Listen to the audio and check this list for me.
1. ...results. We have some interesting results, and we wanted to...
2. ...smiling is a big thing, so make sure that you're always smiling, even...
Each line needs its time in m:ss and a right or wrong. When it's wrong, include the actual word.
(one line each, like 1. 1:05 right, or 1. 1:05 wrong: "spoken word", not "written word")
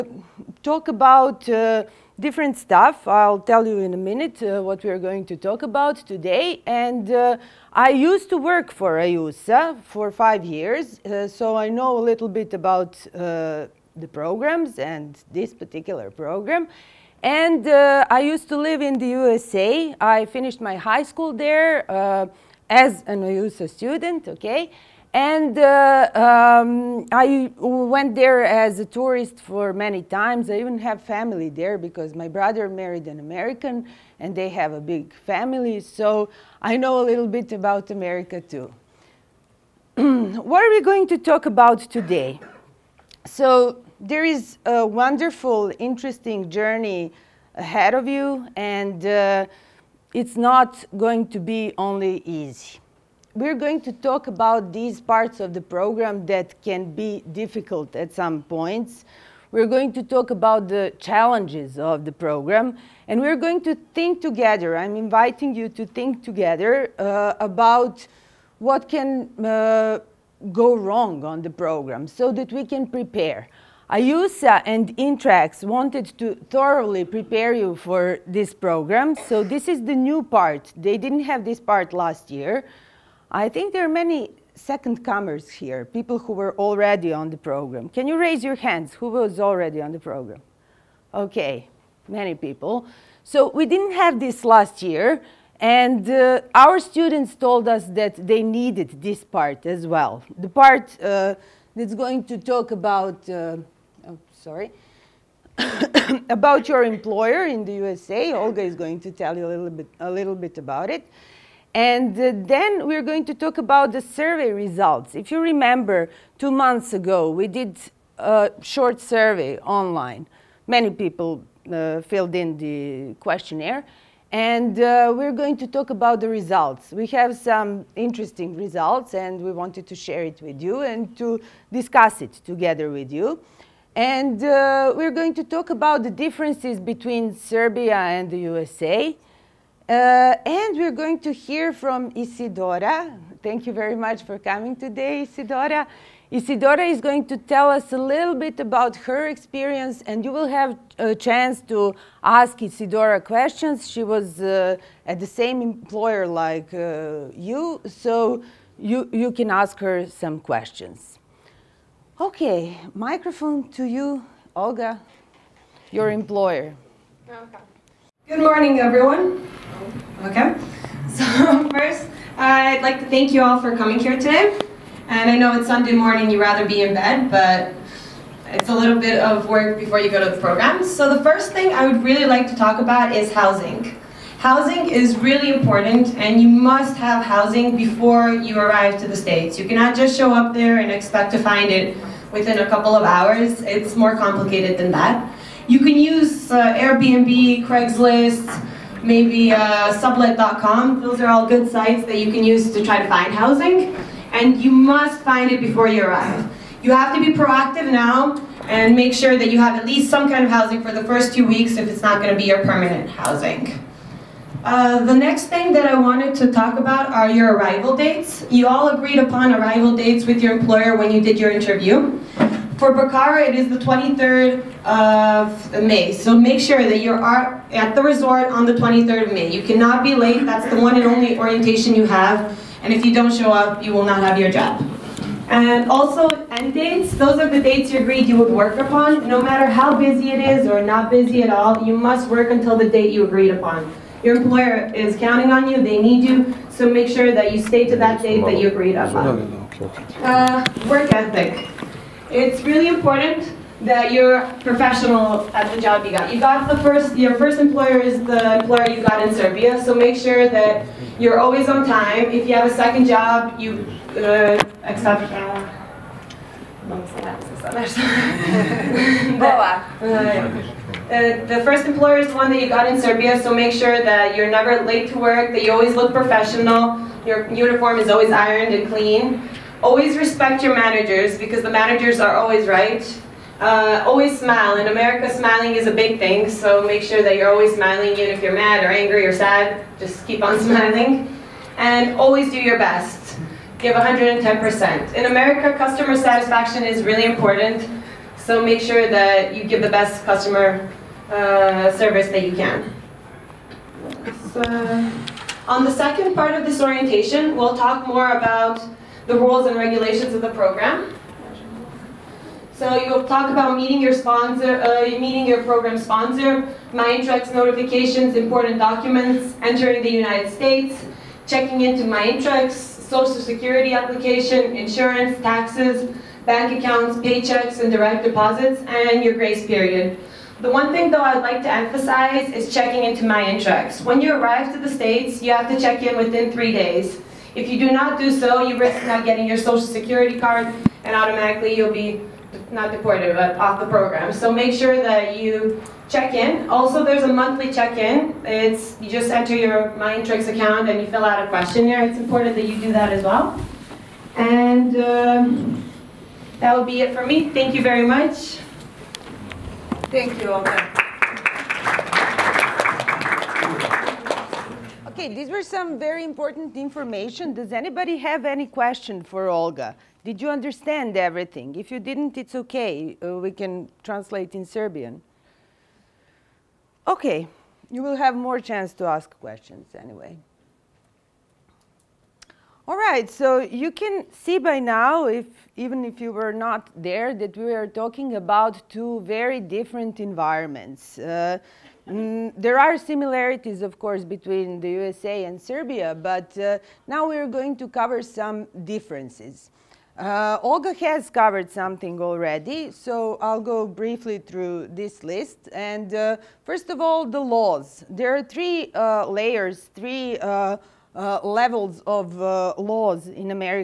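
1. 2:06 right
2. 4:45 right.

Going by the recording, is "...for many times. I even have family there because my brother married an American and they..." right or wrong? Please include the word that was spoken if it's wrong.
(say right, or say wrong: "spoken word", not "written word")
right.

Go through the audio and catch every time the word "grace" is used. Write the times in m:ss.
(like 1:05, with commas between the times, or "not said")
5:29.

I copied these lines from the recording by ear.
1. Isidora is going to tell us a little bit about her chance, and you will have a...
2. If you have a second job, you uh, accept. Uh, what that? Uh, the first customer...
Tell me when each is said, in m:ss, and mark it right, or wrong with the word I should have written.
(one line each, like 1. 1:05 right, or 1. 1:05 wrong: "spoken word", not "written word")
1. 2:26 wrong: "experience", not "chance"
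2. 4:22 wrong: "employer", not "customer".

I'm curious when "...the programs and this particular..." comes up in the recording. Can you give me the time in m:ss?
0:13.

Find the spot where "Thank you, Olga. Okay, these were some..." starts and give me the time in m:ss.
6:00.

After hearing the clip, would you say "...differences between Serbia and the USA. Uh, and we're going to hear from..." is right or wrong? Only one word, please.
right.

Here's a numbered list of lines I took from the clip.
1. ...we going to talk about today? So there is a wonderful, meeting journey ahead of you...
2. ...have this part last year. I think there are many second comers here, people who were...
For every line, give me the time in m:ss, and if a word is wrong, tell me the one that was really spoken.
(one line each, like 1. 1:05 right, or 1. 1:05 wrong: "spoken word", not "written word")
1. 0:40 wrong: "interesting", not "meeting"
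2. 1:21 right.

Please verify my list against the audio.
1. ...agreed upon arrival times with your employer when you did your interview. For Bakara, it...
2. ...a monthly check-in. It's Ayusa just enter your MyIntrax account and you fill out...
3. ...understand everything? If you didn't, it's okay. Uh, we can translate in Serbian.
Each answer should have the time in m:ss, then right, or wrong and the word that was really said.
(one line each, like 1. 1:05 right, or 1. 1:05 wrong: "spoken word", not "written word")
1. 3:38 wrong: "dates", not "times"
2. 5:47 wrong: "You", not "Ayusa"
3. 6:10 right.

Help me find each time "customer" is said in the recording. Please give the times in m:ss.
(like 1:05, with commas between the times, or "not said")
4:55, 5:00.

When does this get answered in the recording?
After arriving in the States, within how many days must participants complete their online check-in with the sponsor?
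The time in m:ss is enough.
5:36.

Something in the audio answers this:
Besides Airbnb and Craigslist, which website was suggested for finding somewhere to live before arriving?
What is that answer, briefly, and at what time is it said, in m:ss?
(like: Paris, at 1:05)
sublet.com, at 3:19.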